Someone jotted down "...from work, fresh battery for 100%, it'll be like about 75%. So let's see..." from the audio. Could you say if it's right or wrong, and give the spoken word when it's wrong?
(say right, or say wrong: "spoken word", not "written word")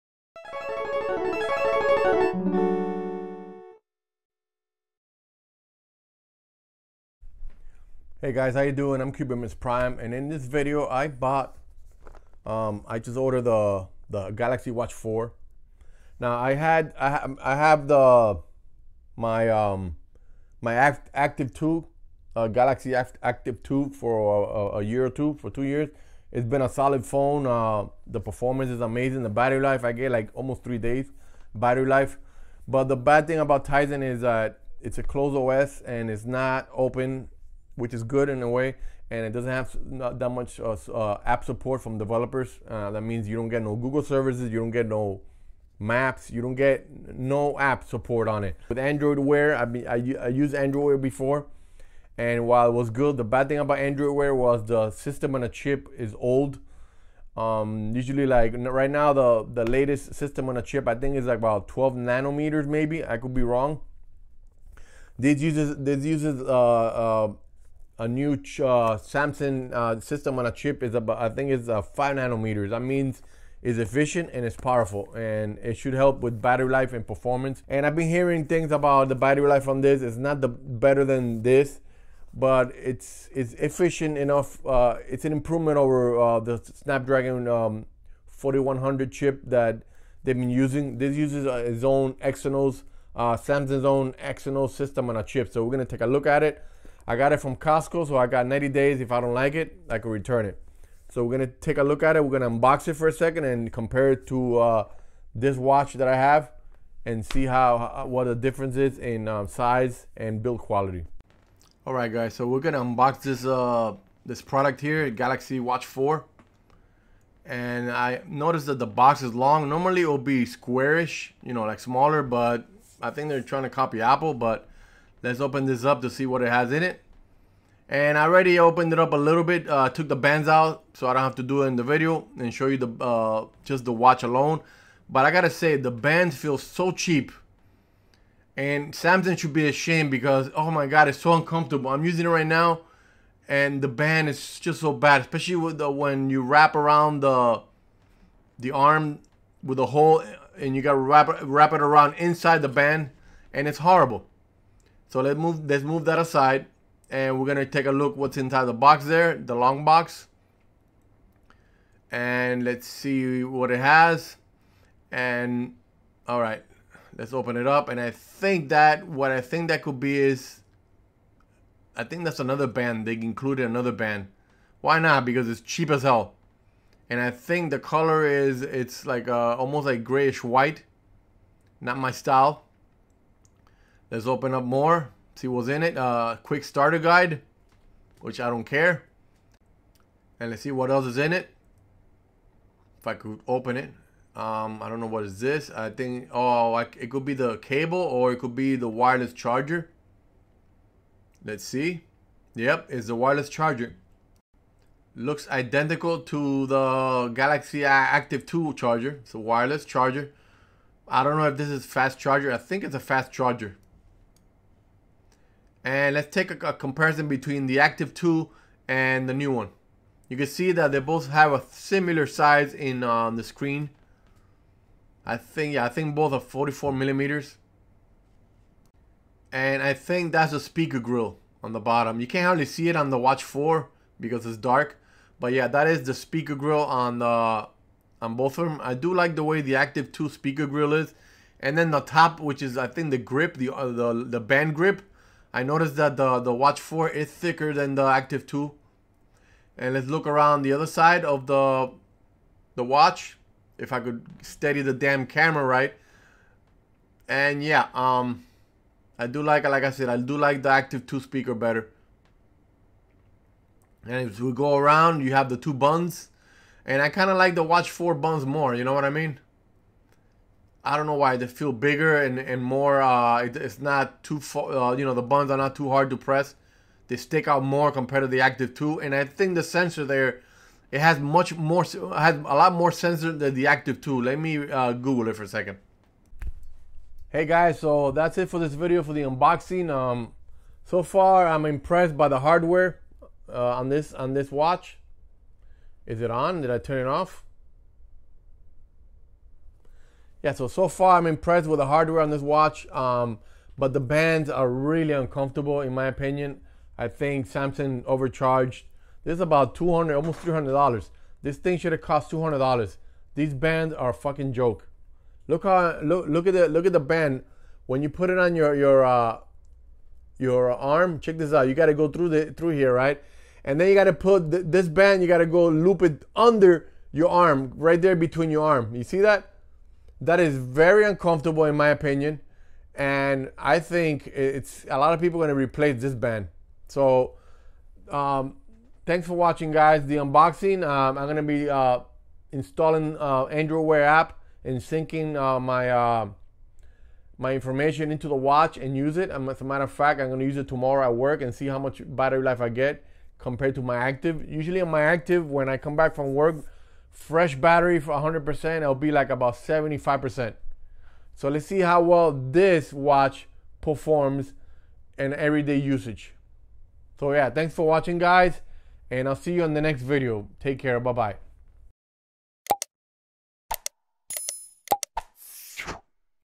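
right.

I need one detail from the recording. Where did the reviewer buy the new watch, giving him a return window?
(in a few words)
Costco.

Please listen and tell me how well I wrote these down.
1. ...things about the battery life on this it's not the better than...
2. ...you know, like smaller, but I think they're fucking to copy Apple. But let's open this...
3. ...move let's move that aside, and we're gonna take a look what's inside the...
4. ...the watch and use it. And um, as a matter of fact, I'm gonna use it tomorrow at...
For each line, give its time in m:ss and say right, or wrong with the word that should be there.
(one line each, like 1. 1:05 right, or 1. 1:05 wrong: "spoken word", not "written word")
1. 1:18 right
2. 2:01 wrong: "trying", not "fucking"
3. 2:35 right
4. 5:48 right.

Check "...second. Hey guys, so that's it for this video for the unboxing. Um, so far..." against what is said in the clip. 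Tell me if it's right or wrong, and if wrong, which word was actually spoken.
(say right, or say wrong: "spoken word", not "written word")
right.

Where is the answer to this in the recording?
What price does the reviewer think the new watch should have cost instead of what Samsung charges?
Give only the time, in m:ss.
5:12.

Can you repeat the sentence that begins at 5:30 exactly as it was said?
That is very uncomfortable, in my opinion.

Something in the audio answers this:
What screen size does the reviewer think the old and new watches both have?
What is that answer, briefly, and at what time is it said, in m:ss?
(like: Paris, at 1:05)
44 millimeters, at 3:46.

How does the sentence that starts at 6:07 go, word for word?
So yeah, thanks for watching, guys and I'll see you on the next video.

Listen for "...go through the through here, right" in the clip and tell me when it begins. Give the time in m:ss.
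5:21.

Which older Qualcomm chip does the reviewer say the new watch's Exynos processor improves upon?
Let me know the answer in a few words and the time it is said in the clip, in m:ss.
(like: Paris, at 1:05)
Snapdragon 4100, at 1:26.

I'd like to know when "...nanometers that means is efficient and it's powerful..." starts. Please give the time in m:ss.
1:12.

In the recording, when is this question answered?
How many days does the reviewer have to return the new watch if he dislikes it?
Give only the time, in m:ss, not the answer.
1:38.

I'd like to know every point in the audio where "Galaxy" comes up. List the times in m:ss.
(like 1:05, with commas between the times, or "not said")
0:14, 0:22, 1:55, 3:27.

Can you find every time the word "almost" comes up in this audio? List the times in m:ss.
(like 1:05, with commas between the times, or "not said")
0:30, 2:59, 5:10.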